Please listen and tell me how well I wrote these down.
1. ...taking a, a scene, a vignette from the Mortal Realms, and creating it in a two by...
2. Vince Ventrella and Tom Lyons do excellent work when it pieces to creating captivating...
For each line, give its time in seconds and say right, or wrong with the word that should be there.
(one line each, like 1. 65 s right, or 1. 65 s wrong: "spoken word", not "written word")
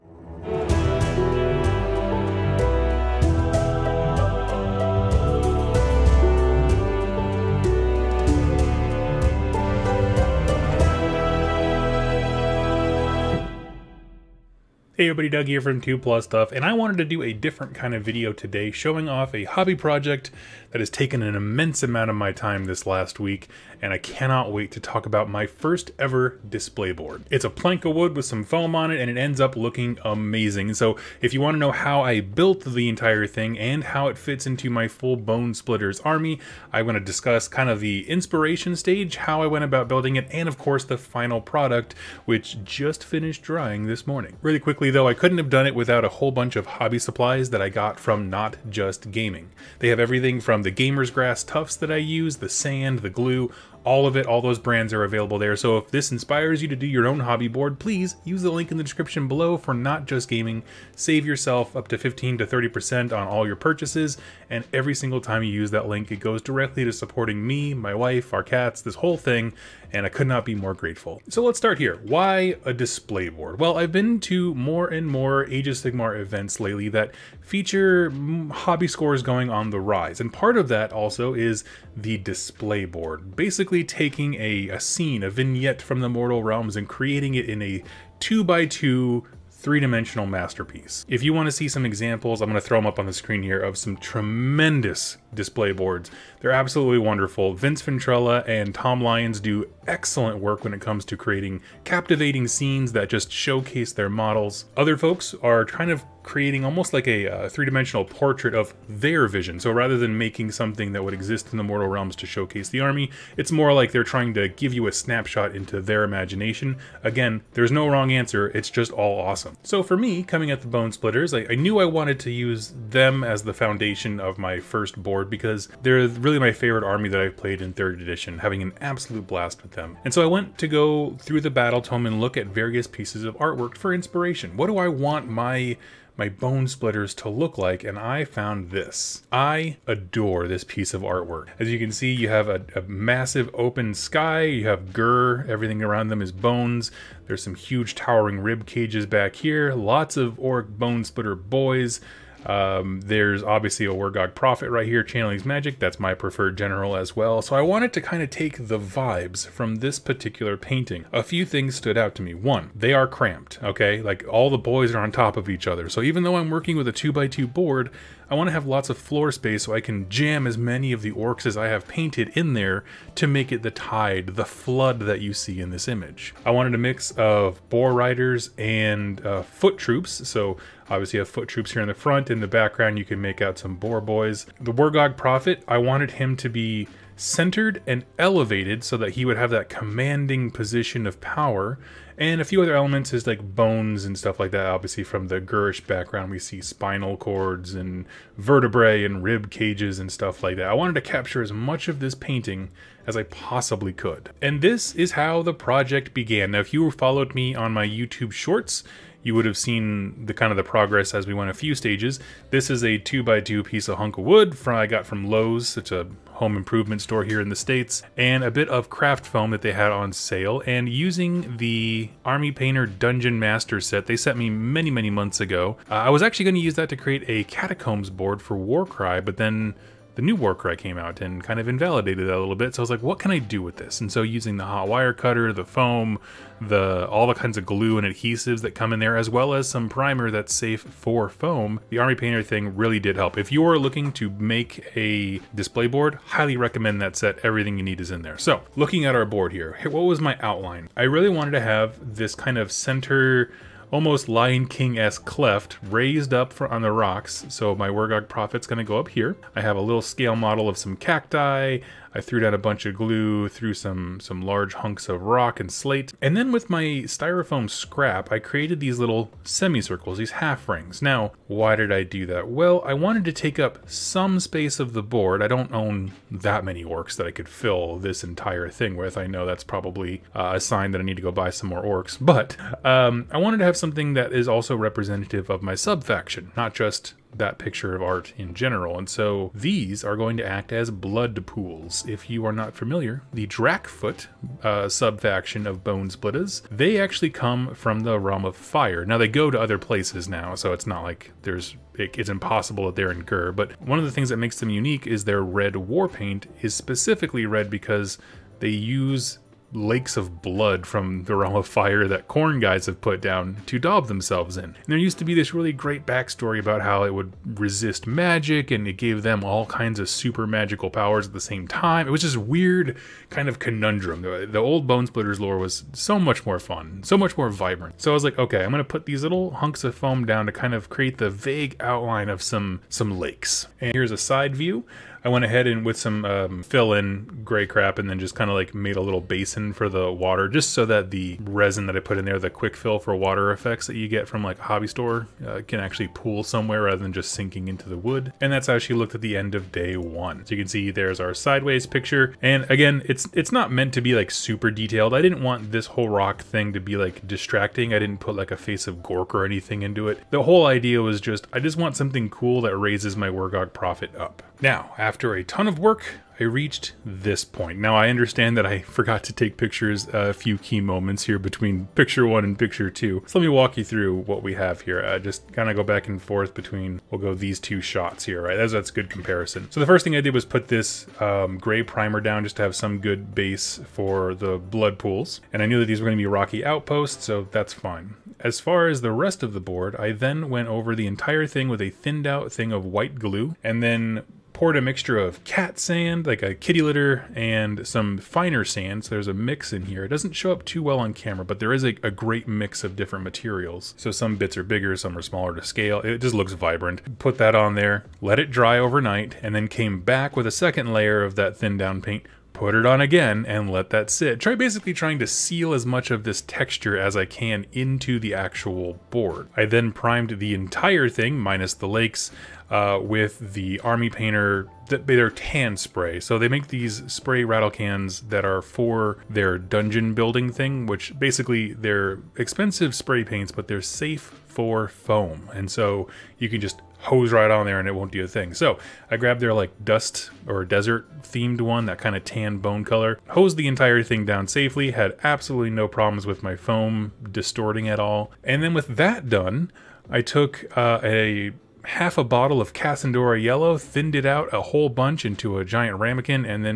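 1. 84 s right
2. 97 s wrong: "comes", not "pieces".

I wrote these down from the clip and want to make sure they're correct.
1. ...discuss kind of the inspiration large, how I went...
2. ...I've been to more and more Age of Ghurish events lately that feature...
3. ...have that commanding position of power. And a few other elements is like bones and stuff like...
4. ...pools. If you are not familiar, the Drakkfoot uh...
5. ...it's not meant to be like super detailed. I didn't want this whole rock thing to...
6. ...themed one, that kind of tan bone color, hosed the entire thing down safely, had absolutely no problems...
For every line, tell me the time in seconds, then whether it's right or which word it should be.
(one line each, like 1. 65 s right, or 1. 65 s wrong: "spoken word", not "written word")
1. 37 s wrong: "stage", not "large"
2. 73 s wrong: "Sigmar", not "Ghurish"
3. 189 s right
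4. 291 s right
5. 353 s right
6. 441 s right.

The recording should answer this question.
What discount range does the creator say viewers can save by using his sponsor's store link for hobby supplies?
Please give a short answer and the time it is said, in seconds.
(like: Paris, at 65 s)
15 to 30%, at 61 s.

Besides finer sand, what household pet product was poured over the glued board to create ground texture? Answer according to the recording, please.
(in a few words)
cat sand.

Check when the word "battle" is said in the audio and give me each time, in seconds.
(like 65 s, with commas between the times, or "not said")
131 s.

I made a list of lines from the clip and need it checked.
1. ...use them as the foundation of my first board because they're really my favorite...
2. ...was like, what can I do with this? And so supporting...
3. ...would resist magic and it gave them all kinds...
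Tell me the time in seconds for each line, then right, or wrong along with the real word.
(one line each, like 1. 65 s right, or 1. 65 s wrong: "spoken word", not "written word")
1. 122 s right
2. 232 s wrong: "using", not "supporting"
3. 317 s right.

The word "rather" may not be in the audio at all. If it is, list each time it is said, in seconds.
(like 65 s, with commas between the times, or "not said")
109 s, 346 s.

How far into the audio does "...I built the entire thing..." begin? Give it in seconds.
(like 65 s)
32 s.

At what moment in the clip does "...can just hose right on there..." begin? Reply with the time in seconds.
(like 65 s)
436 s.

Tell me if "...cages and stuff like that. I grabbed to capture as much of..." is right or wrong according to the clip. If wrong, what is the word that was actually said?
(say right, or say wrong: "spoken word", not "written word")
wrong: "wanted", not "grabbed".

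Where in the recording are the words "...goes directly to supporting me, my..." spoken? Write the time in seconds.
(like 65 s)
66 s.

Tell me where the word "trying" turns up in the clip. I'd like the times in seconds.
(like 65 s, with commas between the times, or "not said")
114 s, 414 s.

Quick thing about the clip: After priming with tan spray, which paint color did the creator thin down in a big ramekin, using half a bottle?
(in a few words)
Casandora Yellow.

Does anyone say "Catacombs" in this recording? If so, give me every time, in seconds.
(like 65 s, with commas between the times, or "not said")
227 s.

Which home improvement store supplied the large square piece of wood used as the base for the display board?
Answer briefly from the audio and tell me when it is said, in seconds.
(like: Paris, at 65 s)
Lowe's, at 215 s.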